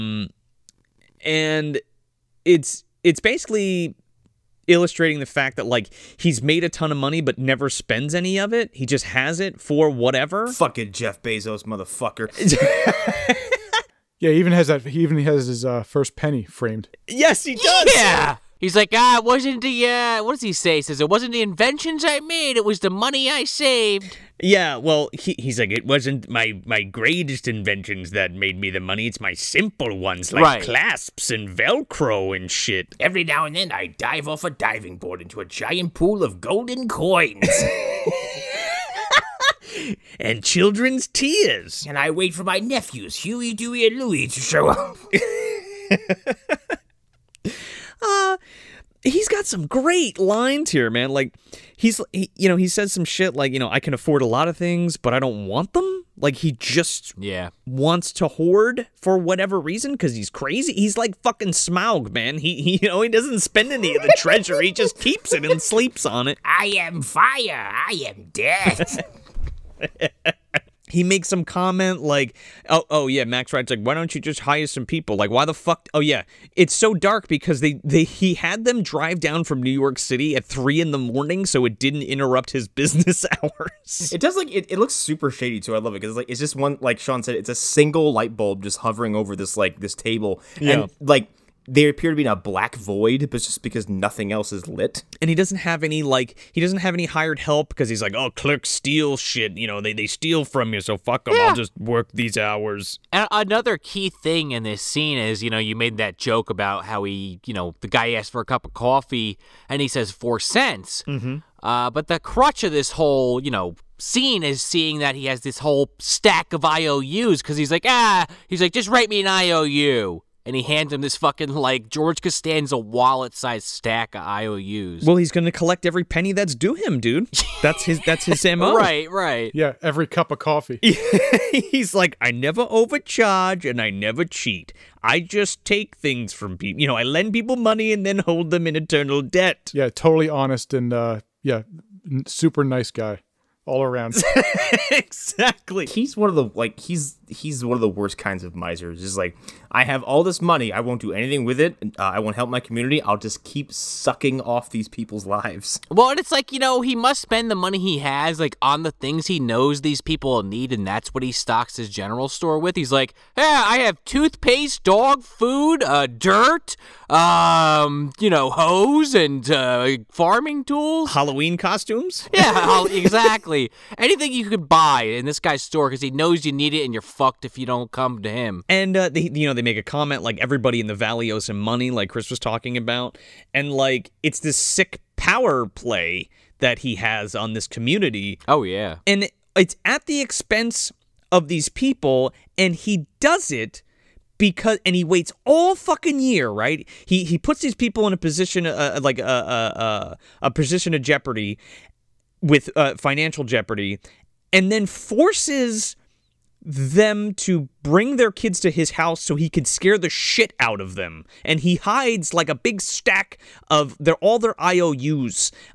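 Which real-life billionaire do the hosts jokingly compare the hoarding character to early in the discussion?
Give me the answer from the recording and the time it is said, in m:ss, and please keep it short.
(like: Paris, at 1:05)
Jeff Bezos, at 0:10.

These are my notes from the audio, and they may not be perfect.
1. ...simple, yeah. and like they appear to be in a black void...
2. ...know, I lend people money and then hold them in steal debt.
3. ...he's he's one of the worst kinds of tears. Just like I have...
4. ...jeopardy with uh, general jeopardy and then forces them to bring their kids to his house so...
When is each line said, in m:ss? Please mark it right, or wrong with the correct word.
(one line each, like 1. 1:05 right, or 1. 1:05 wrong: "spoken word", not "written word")
1. 1:29 wrong: "table", not "simple"
2. 2:16 wrong: "eternal", not "steal"
3. 2:26 wrong: "misers", not "tears"
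4. 3:21 wrong: "financial", not "general".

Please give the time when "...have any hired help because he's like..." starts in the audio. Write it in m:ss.
1:36.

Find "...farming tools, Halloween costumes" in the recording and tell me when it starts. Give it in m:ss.
2:50.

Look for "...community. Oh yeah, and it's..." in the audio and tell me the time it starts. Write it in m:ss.
3:07.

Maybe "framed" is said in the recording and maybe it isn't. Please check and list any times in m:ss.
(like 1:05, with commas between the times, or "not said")
0:16.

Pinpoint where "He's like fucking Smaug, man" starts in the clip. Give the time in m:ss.
1:00.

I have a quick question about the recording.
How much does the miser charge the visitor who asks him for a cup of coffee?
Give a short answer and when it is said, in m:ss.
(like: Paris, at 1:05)
4 cents, at 1:50.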